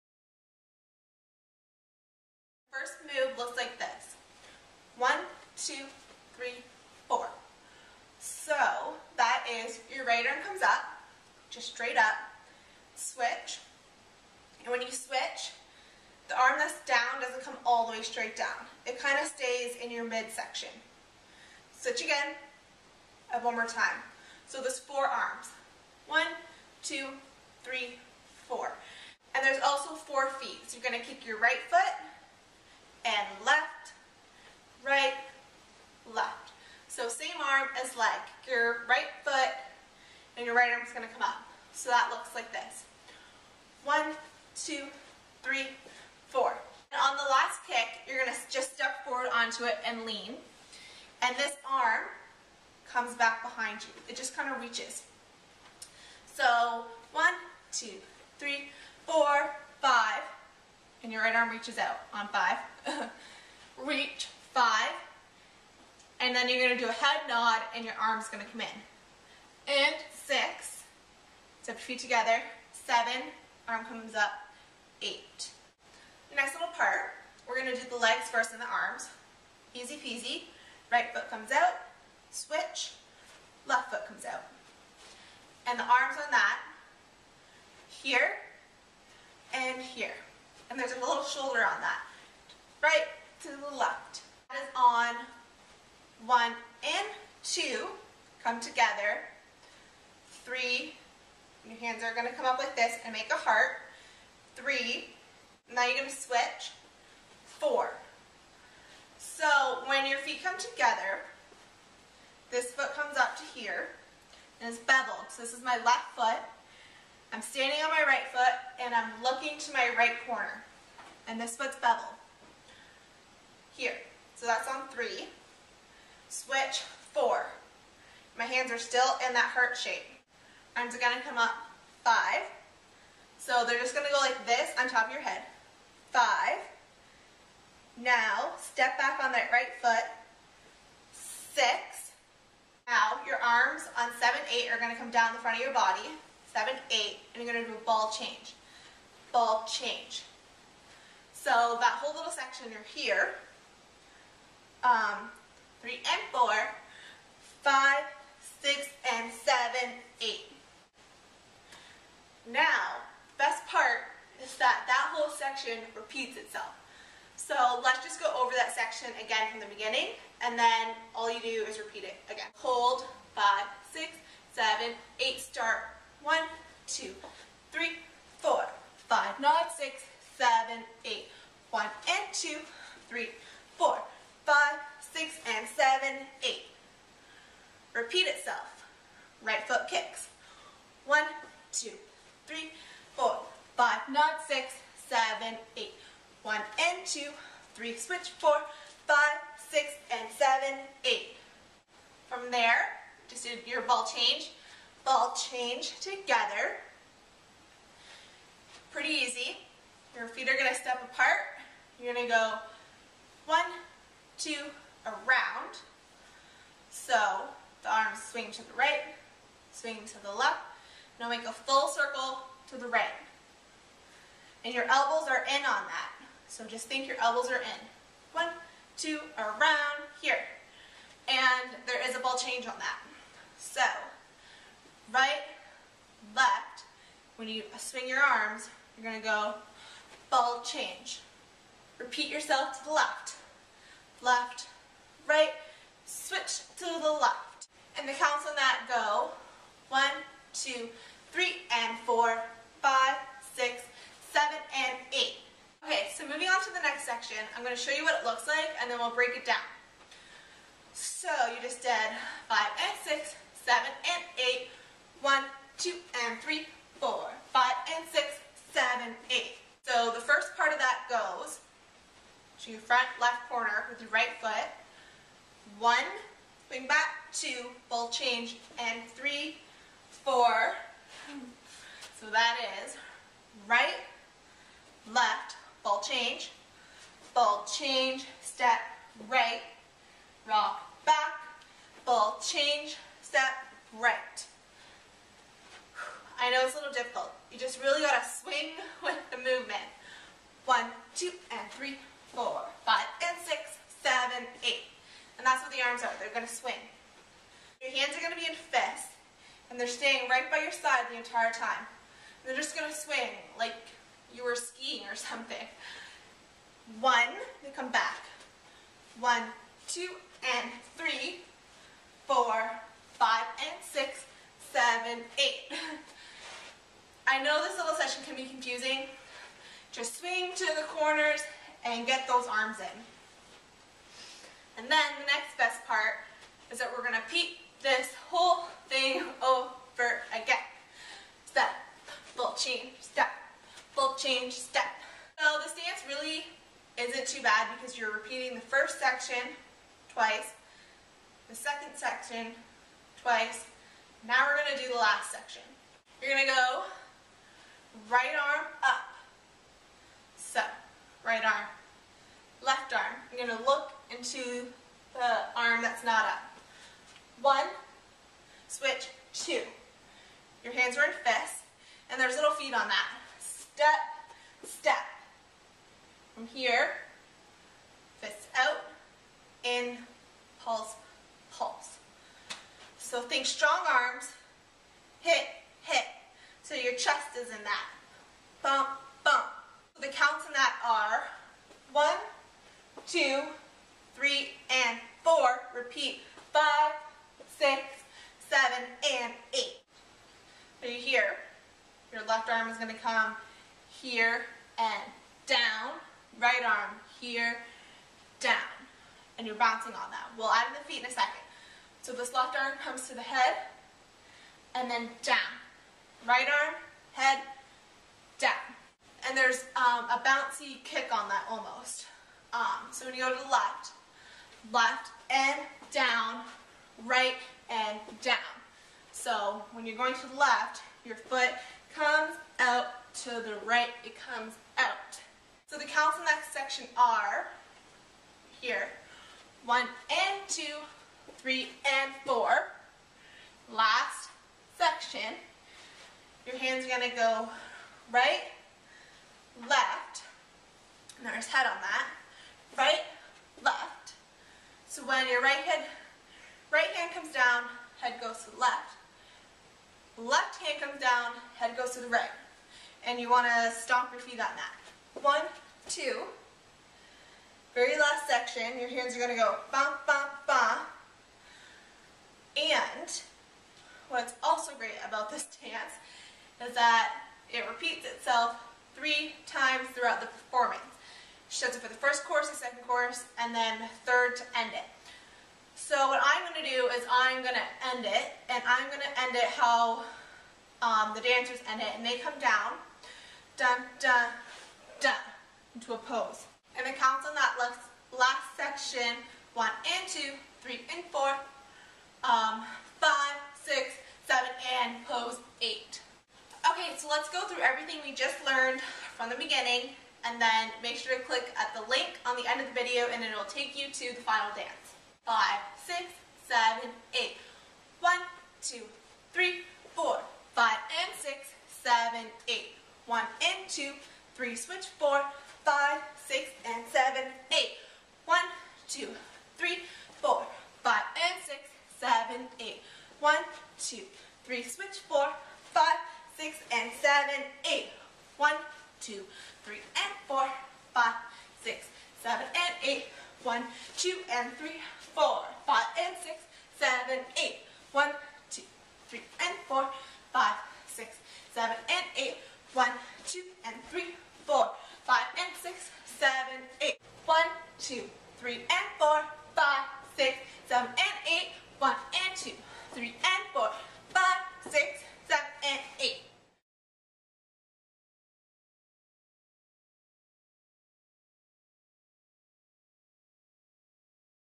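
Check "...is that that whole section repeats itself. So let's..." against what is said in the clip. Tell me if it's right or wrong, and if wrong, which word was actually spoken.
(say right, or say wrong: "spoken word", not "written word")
right.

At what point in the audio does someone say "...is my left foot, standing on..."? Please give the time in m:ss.
1:55.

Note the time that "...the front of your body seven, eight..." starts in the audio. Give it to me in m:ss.
2:25.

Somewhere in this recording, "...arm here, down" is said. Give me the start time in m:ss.
6:46.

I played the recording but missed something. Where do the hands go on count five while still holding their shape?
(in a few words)
On top of your head.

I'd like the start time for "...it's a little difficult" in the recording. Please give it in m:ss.
4:56.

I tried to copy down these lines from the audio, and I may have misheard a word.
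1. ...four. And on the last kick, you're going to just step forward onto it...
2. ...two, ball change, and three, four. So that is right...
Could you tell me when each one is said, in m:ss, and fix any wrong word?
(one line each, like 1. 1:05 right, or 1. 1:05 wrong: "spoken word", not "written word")
1. 0:46 right
2. 4:37 right.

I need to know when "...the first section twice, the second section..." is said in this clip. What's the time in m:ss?
5:48.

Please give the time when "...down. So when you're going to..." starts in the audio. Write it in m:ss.
7:08.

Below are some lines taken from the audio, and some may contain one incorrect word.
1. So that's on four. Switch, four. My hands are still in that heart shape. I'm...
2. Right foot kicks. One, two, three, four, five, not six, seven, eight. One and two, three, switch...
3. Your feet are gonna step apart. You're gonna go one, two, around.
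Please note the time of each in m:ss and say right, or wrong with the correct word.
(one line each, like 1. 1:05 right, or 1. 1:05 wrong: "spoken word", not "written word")
1. 2:04 wrong: "three", not "four"
2. 3:09 right
3. 3:30 right.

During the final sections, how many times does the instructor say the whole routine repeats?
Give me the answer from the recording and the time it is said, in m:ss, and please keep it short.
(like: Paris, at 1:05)
3, at 7:58.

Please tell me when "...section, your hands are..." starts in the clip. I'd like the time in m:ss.
7:48.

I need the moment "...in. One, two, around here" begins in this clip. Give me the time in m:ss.
3:47.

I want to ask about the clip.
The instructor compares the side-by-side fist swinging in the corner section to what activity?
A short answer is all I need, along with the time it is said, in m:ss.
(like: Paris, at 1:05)
Skiing, at 5:14.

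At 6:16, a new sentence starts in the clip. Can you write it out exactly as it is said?
From here, fists out, in, pulse, pulse.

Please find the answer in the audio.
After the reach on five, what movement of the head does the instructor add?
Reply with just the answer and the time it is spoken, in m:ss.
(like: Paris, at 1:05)
Head nod, at 1:06.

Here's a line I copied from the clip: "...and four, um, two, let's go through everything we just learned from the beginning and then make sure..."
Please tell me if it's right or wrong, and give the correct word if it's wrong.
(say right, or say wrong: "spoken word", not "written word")
wrong: "five", not "two".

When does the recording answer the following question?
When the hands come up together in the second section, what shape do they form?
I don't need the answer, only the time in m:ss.
1:43.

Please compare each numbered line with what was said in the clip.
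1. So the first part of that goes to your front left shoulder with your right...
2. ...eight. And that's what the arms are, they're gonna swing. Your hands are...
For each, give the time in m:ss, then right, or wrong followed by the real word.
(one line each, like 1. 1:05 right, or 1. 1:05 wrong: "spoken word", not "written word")
1. 4:29 wrong: "corner", not "shoulder"
2. 5:04 right.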